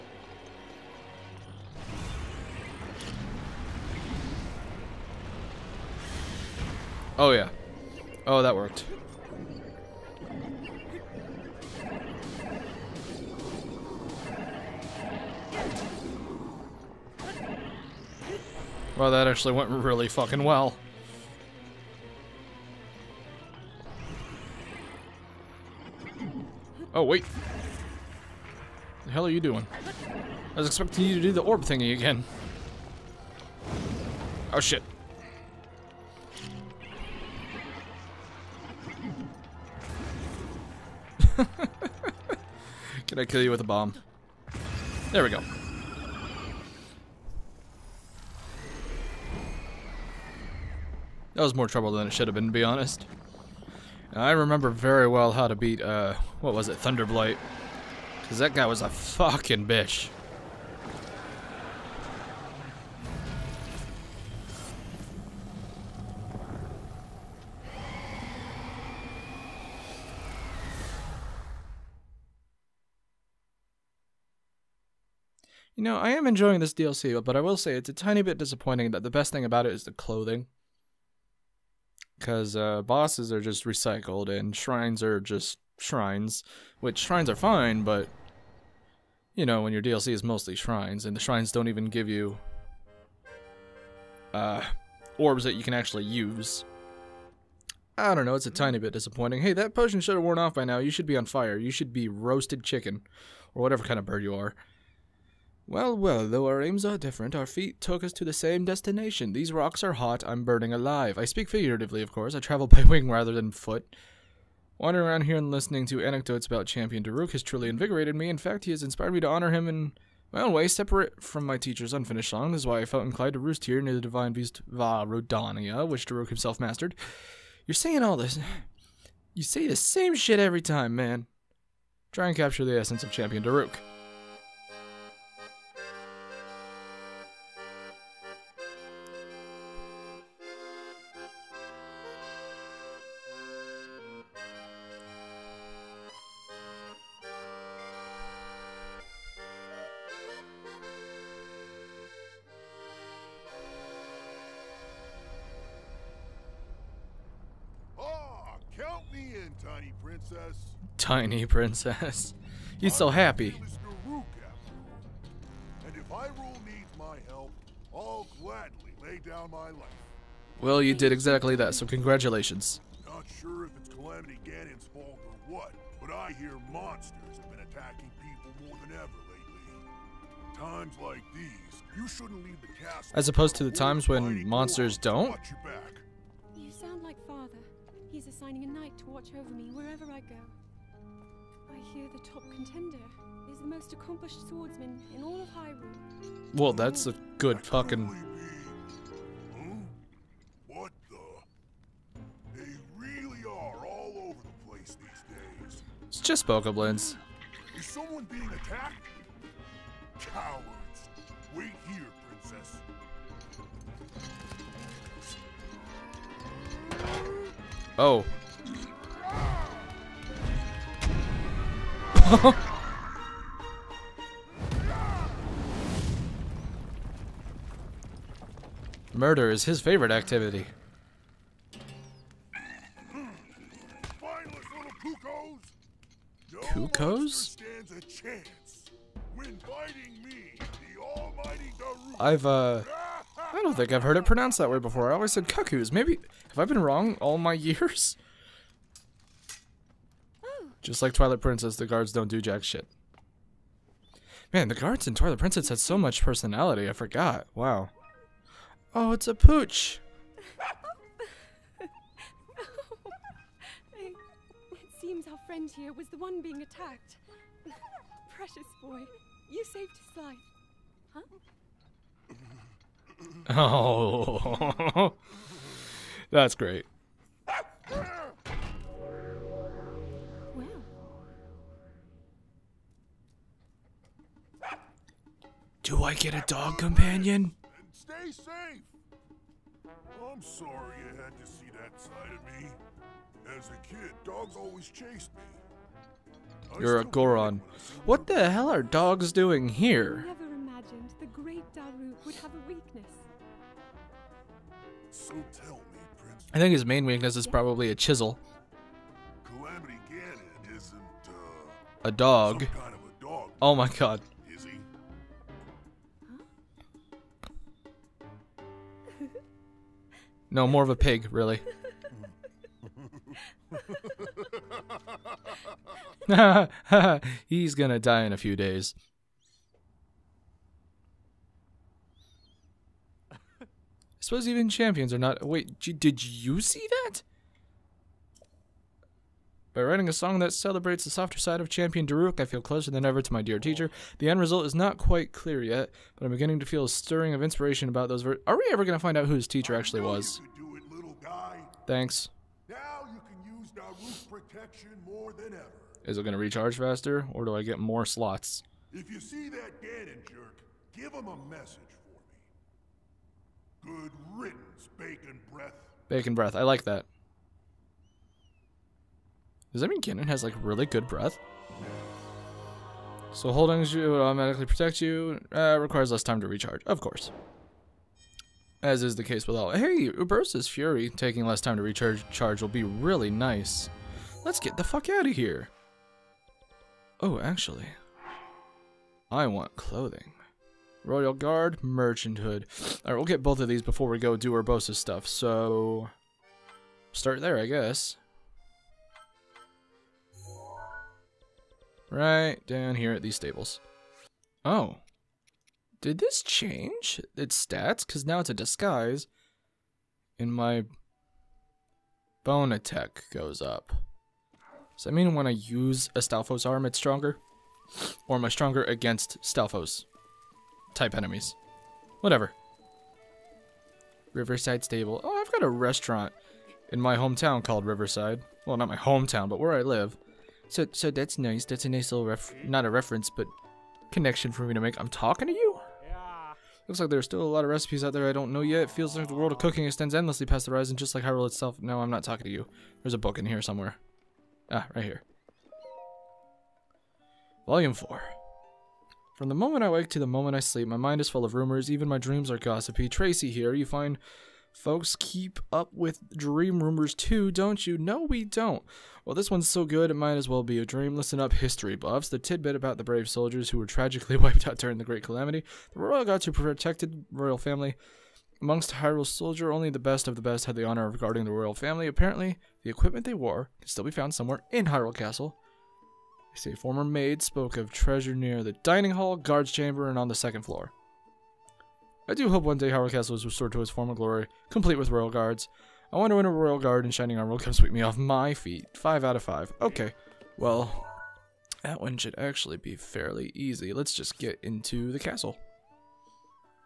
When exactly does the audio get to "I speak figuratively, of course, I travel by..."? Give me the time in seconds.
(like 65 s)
111 s.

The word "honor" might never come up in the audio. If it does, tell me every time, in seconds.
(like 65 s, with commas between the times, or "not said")
119 s, 470 s.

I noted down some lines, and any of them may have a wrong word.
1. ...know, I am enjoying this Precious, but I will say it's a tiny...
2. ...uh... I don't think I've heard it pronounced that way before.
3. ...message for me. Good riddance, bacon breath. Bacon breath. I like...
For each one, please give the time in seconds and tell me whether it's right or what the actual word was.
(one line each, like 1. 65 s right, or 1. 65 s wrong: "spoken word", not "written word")
1. 75 s wrong: "DLC", not "Precious"
2. 242 s right
3. 361 s right.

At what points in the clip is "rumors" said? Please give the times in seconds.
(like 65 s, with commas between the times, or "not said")
451 s, 456 s.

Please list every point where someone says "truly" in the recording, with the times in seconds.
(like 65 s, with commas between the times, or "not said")
117 s.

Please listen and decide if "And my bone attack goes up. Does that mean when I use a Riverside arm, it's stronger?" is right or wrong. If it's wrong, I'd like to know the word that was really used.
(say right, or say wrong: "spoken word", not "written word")
wrong: "Stalfos", not "Riverside".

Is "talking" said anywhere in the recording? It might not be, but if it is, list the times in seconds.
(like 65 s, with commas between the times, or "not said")
435 s, 442 s.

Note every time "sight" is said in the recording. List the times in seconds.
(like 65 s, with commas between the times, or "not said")
not said.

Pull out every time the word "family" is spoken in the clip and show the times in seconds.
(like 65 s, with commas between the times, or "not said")
467 s, 471 s.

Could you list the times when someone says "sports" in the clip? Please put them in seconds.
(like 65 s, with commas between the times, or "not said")
not said.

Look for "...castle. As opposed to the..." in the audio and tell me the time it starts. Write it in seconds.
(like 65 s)
182 s.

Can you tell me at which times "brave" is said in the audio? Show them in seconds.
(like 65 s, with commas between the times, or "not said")
463 s.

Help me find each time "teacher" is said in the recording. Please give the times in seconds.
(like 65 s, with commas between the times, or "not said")
121 s, 343 s, 349 s.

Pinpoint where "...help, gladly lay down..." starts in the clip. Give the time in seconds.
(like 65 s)
167 s.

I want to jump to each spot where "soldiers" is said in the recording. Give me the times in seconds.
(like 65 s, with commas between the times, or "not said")
463 s, 469 s.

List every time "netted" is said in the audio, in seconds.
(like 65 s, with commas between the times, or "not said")
not said.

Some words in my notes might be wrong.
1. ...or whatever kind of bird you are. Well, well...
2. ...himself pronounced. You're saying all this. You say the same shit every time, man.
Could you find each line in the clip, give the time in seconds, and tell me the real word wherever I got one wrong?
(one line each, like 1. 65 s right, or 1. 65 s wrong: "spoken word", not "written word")
1. 103 s right
2. 126 s wrong: "mastered", not "pronounced".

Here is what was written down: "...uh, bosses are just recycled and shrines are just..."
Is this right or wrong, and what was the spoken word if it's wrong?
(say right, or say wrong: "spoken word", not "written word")
right.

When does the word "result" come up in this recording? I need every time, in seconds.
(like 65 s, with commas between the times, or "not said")
344 s.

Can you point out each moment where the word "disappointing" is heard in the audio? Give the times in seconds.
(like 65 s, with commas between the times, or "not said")
78 s, 98 s.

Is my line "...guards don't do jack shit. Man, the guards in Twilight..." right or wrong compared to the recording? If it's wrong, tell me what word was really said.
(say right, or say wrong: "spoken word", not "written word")
right.